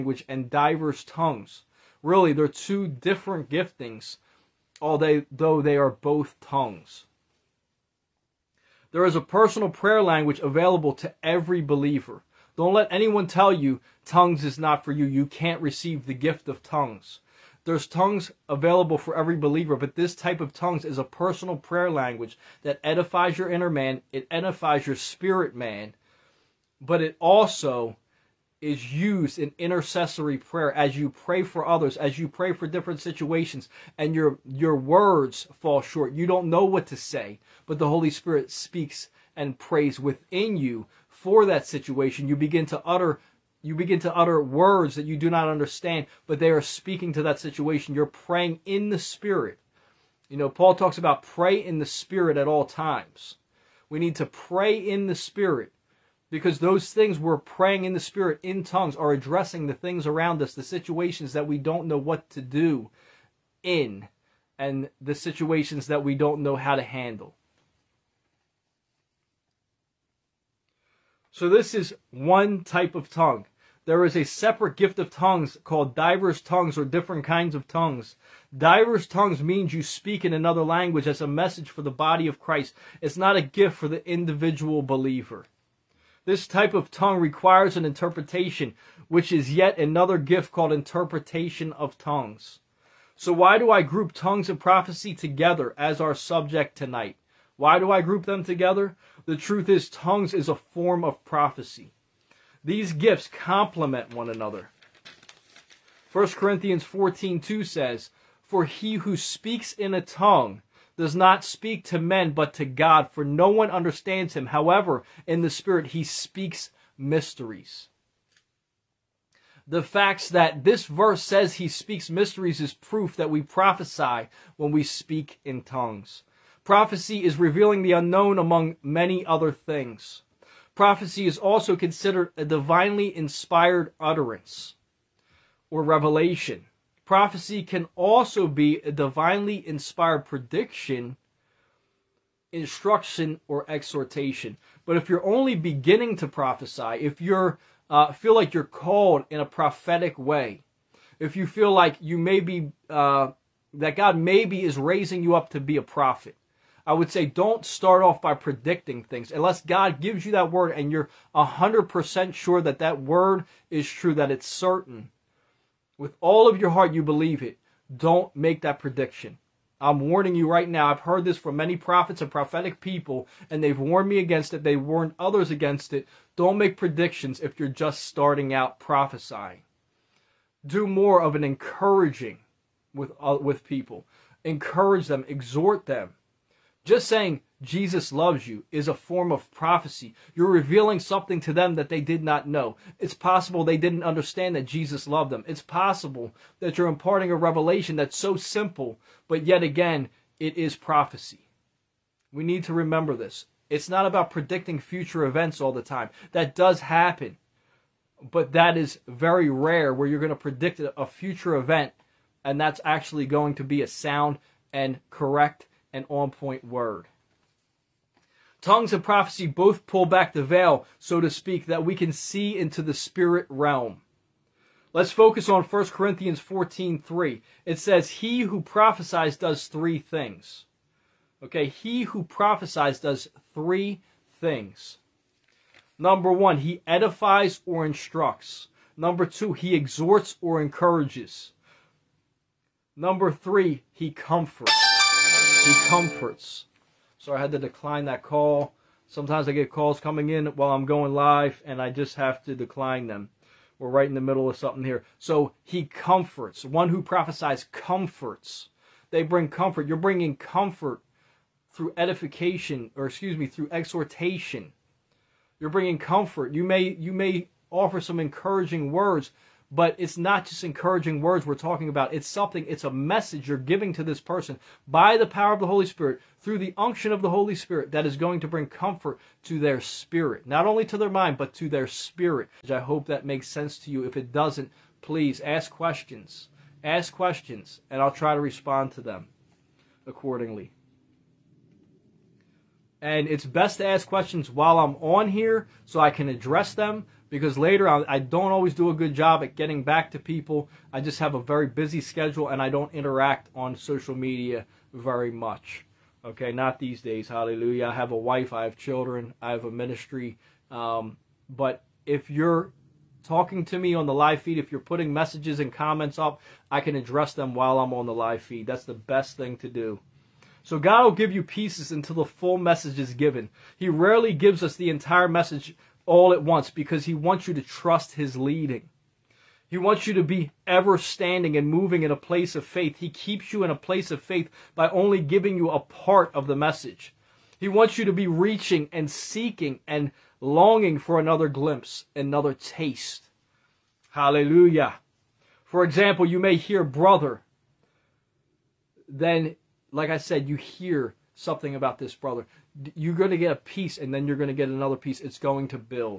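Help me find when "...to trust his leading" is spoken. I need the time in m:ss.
5:27.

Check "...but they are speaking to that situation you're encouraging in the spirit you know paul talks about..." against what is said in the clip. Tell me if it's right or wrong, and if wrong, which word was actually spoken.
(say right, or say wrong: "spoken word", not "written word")
wrong: "praying", not "encouraging".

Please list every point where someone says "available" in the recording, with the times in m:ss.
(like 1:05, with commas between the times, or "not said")
0:10, 0:18.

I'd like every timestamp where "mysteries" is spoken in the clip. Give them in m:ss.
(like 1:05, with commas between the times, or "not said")
1:56, 2:02.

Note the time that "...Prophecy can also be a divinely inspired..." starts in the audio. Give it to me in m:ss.
2:17.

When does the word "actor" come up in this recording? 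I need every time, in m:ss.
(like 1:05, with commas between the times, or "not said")
not said.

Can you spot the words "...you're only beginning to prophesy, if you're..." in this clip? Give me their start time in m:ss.
2:25.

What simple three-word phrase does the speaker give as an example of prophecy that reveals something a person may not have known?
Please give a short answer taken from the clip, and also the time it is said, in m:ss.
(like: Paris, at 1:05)
Jesus loves you, at 3:07.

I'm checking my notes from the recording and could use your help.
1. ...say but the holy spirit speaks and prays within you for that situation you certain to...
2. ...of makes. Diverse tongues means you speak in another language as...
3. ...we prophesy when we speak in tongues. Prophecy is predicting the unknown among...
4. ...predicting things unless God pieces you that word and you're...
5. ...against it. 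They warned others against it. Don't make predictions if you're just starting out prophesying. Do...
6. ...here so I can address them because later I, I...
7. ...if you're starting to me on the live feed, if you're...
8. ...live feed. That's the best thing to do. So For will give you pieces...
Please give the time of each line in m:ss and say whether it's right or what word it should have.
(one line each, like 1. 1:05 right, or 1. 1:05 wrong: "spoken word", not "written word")
1. 0:36 wrong: "begin", not "certain"
2. 1:17 wrong: "tongues", not "makes"
3. 2:03 wrong: "revealing", not "predicting"
4. 2:38 wrong: "gives", not "pieces"
5. 2:54 right
6. 4:55 right
7. 5:12 wrong: "talking", not "starting"
8. 5:18 wrong: "God", not "For".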